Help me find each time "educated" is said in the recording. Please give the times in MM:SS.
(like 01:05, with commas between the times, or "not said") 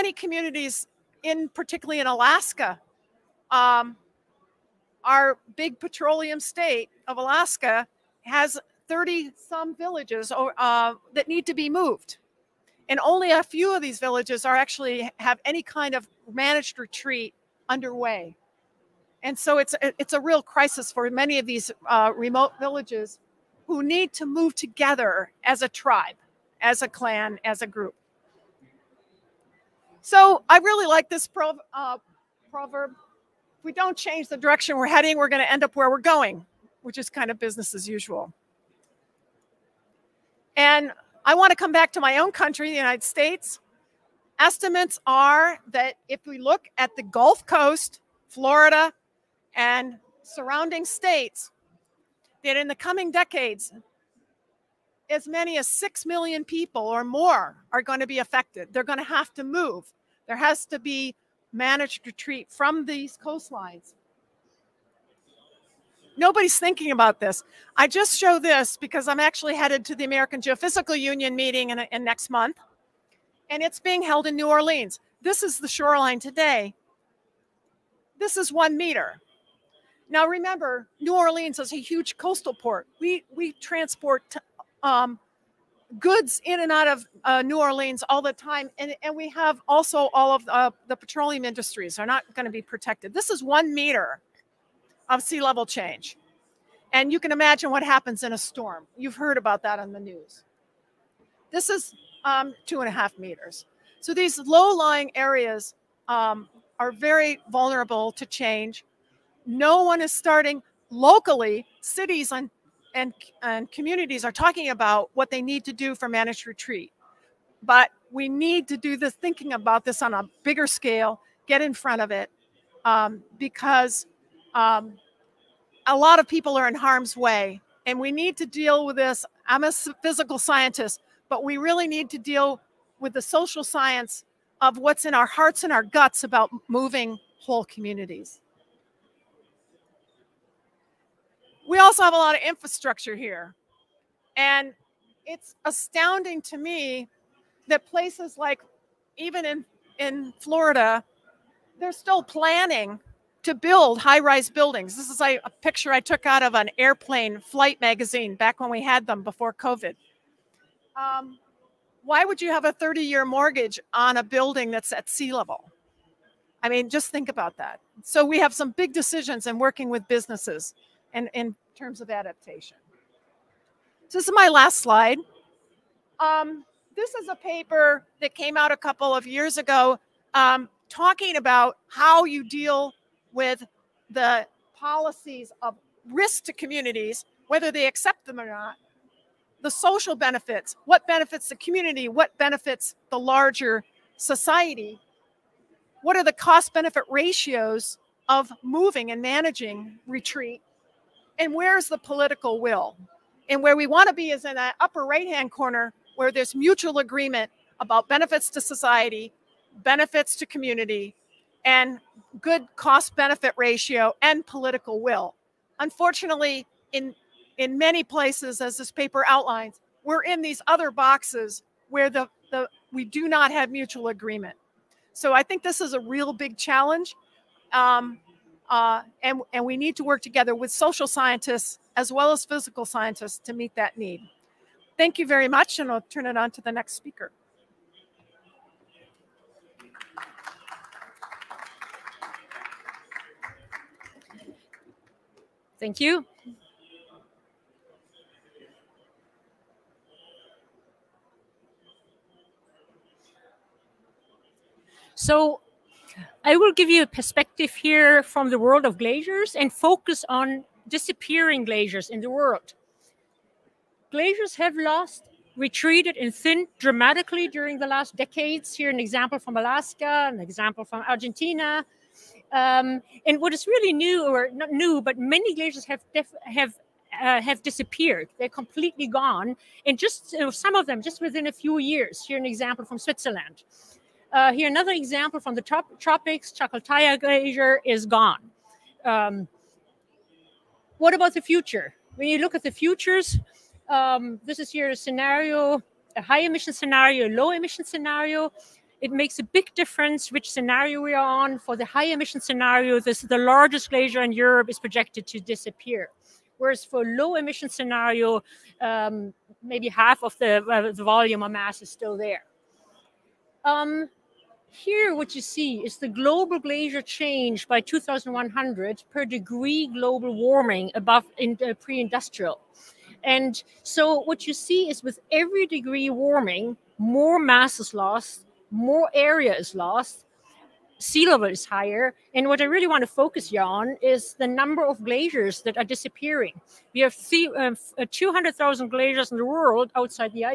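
not said.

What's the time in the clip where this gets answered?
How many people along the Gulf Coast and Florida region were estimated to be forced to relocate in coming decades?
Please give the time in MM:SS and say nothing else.
00:55.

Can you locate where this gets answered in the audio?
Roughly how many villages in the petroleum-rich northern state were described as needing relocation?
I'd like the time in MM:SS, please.
00:08.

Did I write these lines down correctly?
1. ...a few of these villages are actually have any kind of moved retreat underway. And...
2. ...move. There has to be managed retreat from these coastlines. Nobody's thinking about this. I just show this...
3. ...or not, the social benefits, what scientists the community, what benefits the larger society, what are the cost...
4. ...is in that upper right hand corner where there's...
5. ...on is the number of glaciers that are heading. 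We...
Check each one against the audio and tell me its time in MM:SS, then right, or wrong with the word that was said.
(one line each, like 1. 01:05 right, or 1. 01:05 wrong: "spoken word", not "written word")
1. 00:13 wrong: "managed", not "moved"
2. 00:59 right
3. 03:08 wrong: "benefits", not "scientists"
4. 03:24 right
5. 05:33 wrong: "disappearing", not "heading".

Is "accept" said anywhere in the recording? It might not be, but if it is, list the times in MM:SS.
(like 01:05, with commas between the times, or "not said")
03:07.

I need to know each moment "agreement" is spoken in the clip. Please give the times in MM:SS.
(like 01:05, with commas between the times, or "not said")
03:26, 03:44.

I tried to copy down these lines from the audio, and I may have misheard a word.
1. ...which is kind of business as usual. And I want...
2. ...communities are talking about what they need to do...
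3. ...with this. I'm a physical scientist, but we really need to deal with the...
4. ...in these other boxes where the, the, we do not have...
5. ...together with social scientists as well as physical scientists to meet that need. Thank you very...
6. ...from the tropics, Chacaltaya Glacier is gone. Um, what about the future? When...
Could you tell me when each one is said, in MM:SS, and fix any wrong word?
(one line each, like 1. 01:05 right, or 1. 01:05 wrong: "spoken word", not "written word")
1. 00:36 right
2. 01:53 right
3. 02:08 right
4. 03:40 right
5. 03:50 right
6. 04:45 right.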